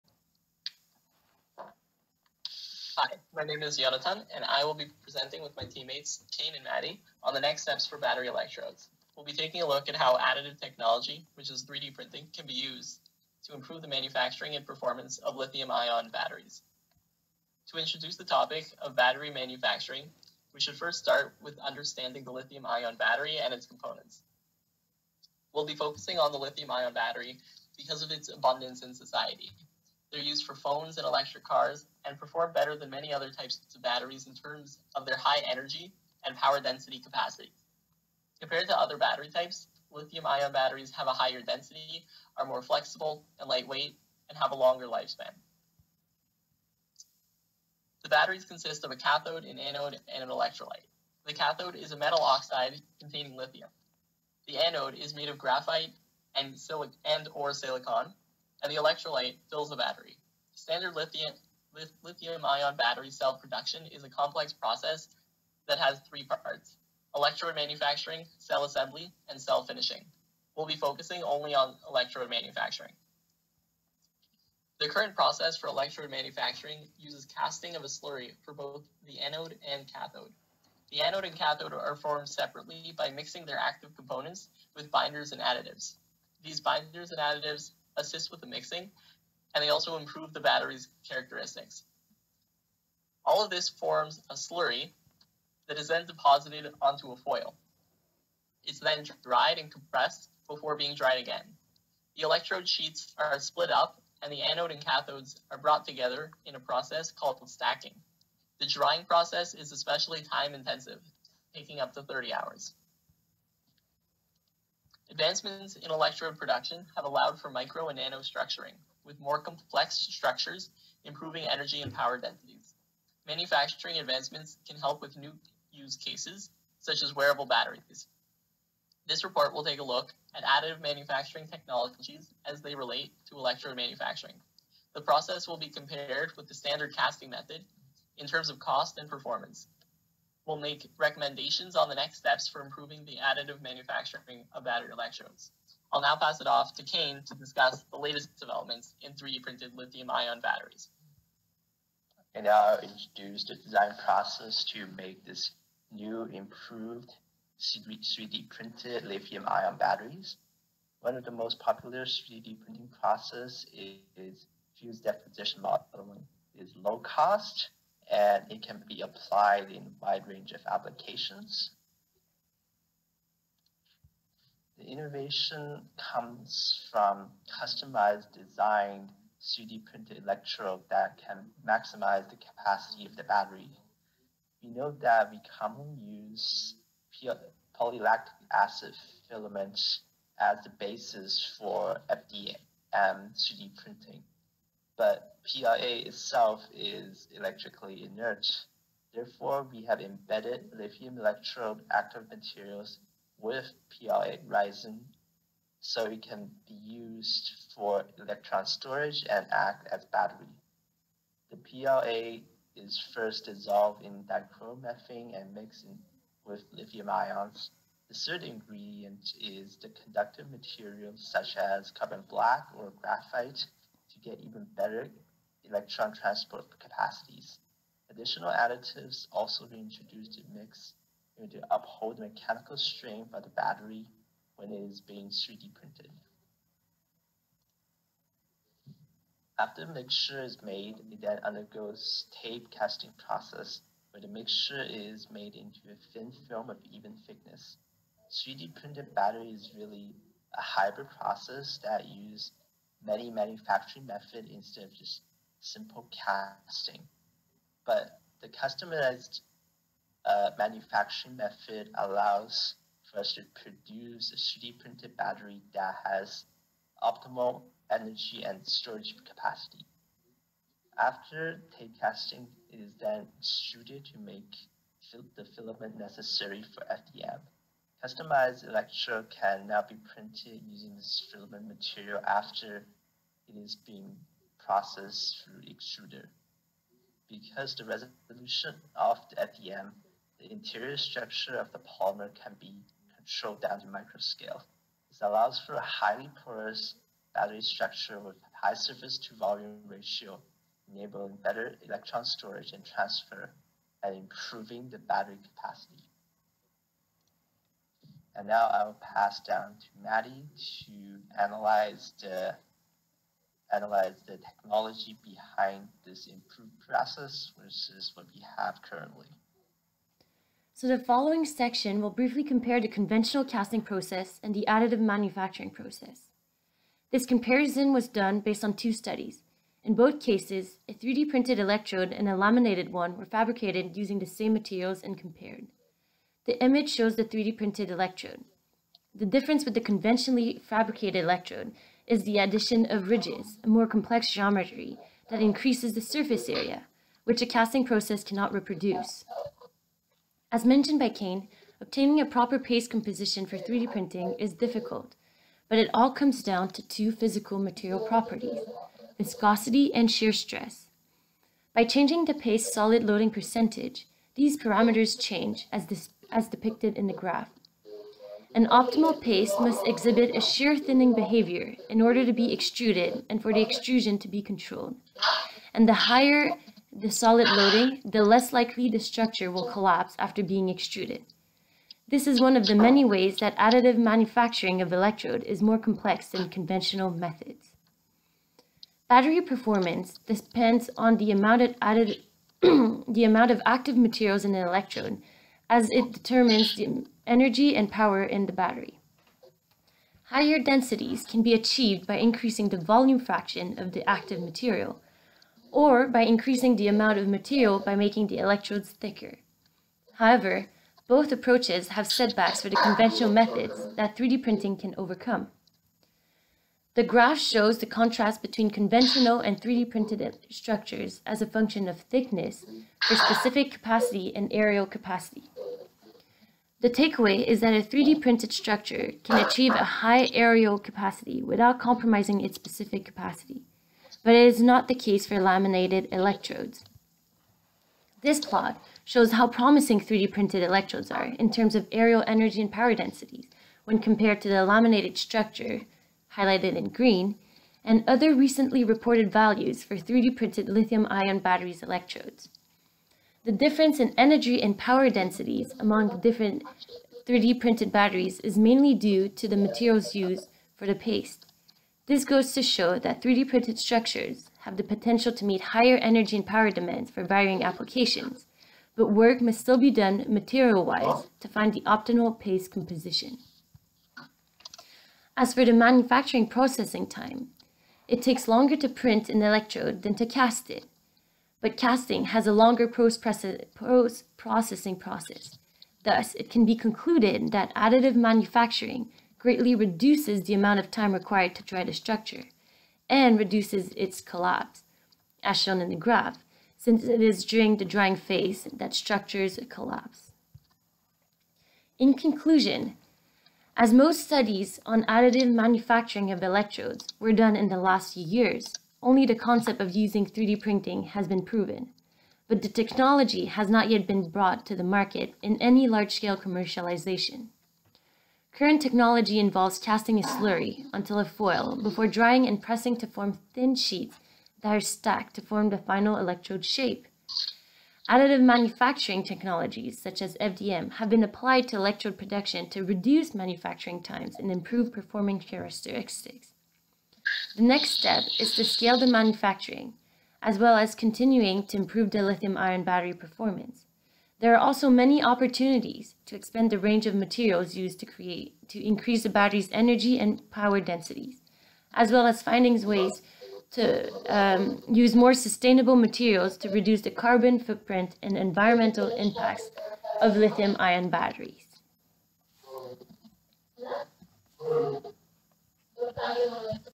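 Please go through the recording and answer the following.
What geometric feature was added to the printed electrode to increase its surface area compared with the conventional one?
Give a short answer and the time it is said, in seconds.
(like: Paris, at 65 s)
ridges, at 343 s.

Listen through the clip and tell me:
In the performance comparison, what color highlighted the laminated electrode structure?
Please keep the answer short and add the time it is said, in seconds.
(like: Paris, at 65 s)
green, at 446 s.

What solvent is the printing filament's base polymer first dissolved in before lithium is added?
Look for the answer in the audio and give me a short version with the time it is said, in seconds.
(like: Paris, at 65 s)
dichloromethane, at 214 s.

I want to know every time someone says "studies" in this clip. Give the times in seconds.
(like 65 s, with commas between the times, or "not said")
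328 s, 504 s.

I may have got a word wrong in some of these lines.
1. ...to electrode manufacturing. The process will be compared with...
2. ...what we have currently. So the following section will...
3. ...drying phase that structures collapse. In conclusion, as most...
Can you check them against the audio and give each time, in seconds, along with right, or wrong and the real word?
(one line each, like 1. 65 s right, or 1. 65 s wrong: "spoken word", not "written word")
1. 133 s right
2. 318 s right
3. 497 s right.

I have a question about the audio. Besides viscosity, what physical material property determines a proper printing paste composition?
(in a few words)
shear stress.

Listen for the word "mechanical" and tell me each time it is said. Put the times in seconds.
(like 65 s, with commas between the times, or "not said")
232 s.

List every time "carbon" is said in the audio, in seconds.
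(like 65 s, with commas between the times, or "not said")
221 s, 557 s.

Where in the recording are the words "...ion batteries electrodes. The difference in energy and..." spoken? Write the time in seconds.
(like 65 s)
451 s.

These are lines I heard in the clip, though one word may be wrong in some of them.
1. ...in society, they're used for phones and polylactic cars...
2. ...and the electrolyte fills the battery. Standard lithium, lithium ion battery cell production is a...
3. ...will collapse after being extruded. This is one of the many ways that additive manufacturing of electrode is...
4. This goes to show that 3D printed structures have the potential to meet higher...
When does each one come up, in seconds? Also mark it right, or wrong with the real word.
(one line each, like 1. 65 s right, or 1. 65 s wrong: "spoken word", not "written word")
1. 28 s wrong: "electric", not "polylactic"
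2. 58 s right
3. 379 s right
4. 462 s right.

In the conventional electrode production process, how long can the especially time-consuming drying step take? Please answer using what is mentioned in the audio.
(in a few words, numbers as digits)
30 hours.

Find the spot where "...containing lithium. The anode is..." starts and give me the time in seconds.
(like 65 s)
52 s.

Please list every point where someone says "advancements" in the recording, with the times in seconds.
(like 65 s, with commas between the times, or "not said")
115 s, 123 s.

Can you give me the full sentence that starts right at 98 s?
It's then dried and compressed before being dried again.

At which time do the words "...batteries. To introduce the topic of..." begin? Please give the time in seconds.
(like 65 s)
16 s.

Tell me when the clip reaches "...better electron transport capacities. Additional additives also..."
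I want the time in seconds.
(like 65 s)
224 s.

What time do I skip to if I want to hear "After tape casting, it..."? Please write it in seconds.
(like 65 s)
270 s.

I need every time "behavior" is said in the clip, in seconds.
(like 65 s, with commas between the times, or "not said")
371 s.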